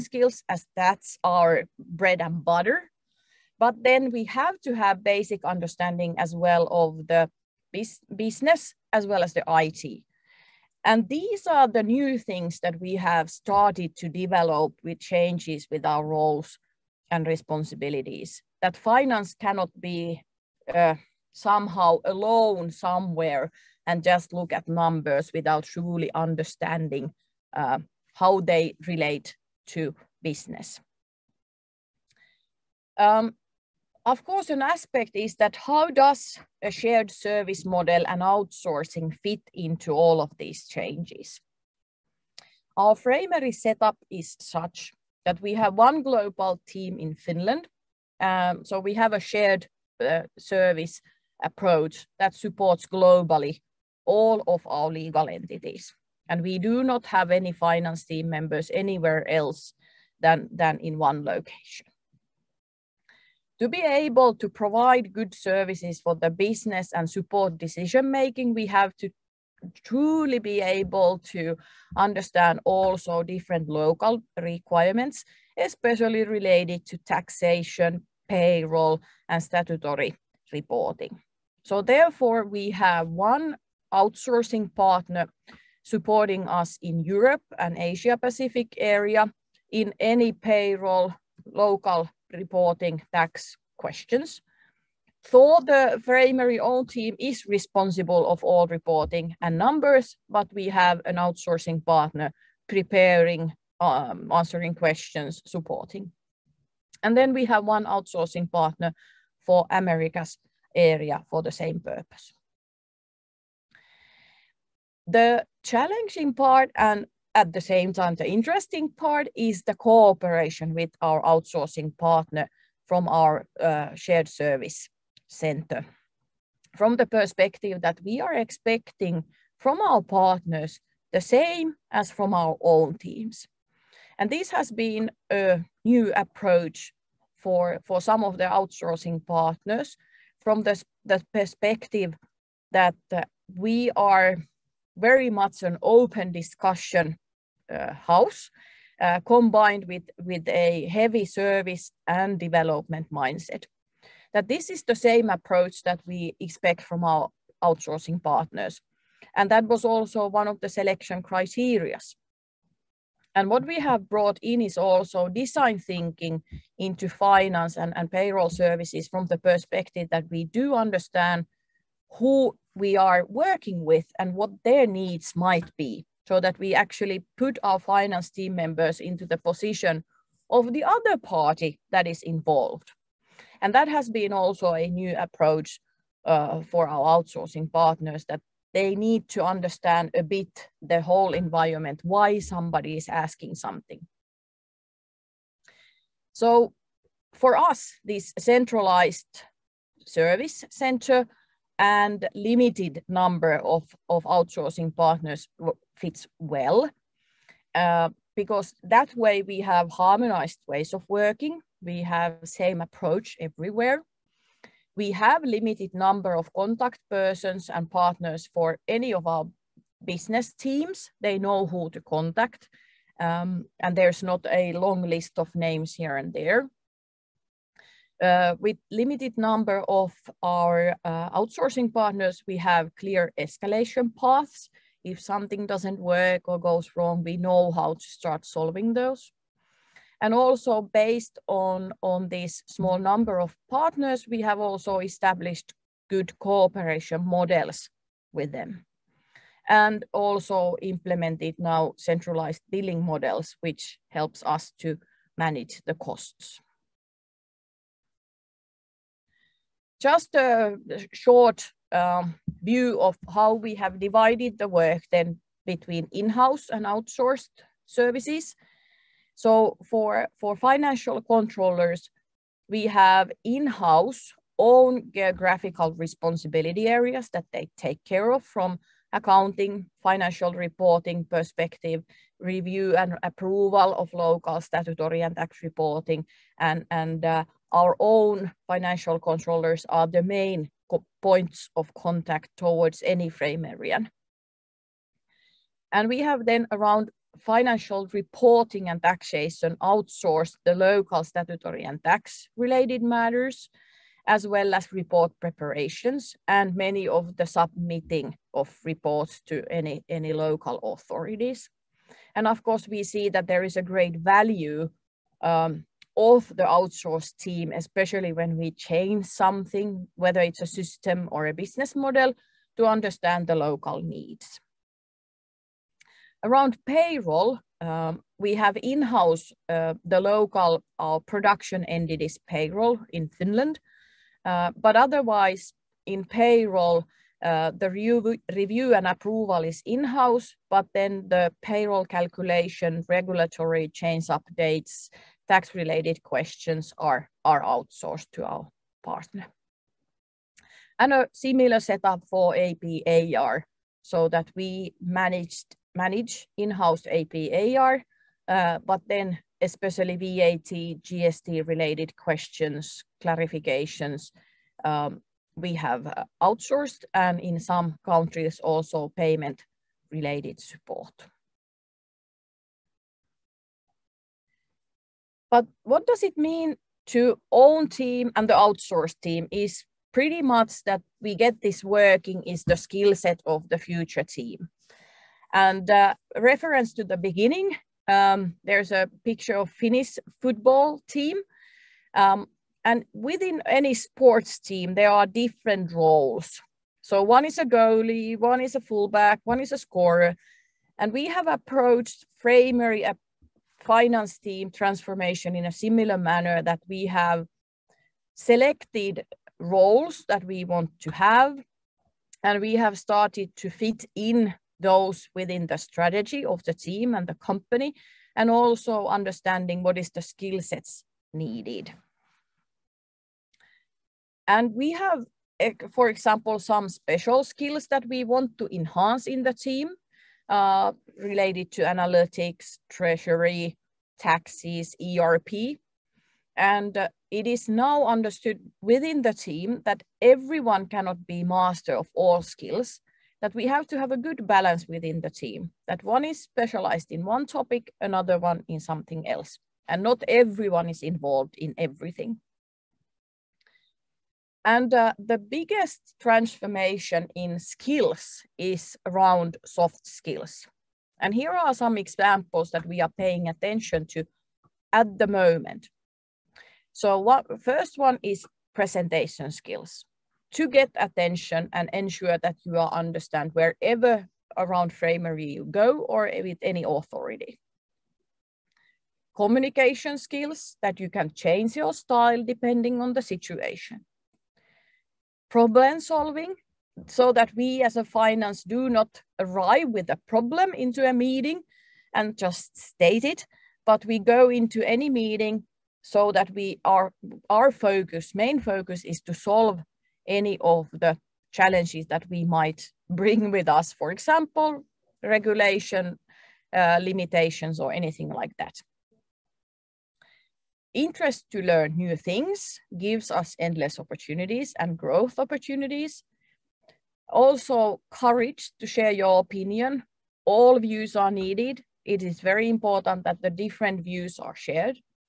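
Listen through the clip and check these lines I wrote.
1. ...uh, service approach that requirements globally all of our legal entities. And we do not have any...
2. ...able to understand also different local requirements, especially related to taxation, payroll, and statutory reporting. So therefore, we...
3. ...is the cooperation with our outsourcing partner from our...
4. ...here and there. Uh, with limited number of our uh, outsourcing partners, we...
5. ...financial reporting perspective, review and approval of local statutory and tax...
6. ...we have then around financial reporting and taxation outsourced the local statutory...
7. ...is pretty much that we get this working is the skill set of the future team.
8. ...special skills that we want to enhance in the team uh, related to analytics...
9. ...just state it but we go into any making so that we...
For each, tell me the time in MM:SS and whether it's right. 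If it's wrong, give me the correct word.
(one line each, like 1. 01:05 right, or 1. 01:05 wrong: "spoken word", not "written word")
1. 00:50 wrong: "supports", not "requirements"
2. 01:10 right
3. 01:59 right
4. 03:45 right
5. 04:40 right
6. 04:56 right
7. 06:19 right
8. 07:06 right
9. 08:12 wrong: "meeting", not "making".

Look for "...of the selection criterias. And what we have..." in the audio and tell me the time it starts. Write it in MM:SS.
02:40.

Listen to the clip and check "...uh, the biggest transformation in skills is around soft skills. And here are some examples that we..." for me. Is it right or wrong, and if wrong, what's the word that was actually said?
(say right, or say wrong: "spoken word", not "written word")
right.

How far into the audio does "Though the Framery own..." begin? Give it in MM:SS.
01:35.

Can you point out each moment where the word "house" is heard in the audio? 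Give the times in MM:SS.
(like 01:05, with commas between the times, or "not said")
02:27, 04:26, 04:33, 05:28, 05:39, 05:56.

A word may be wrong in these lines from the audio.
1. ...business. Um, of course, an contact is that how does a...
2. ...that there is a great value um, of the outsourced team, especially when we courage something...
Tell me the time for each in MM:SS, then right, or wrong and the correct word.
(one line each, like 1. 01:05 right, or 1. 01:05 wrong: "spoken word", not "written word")
1. 00:30 wrong: "aspect", not "contact"
2. 05:13 wrong: "change", not "courage".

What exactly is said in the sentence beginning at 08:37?
Also, courage to share your opinion.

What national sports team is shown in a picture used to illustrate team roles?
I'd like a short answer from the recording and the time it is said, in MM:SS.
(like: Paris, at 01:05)
Finnish football team, at 06:29.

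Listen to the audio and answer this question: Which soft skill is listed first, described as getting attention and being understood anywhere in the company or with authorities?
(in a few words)
Presentation skills.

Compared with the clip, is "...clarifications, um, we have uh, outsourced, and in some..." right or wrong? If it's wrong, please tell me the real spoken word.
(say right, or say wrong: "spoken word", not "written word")
right.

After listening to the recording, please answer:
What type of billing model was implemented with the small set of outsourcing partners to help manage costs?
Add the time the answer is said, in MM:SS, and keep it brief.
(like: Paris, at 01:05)
Centralized billing, at 04:11.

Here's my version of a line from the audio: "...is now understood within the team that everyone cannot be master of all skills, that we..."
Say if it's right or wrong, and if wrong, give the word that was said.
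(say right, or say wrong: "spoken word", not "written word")
right.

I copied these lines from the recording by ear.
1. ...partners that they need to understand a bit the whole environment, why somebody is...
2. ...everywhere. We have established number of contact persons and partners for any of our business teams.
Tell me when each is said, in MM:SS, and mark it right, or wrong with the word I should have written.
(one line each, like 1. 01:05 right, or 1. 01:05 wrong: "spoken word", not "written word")
1. 03:07 right
2. 03:33 wrong: "limited", not "established".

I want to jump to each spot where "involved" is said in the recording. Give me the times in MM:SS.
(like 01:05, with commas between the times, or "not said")
03:02, 07:31.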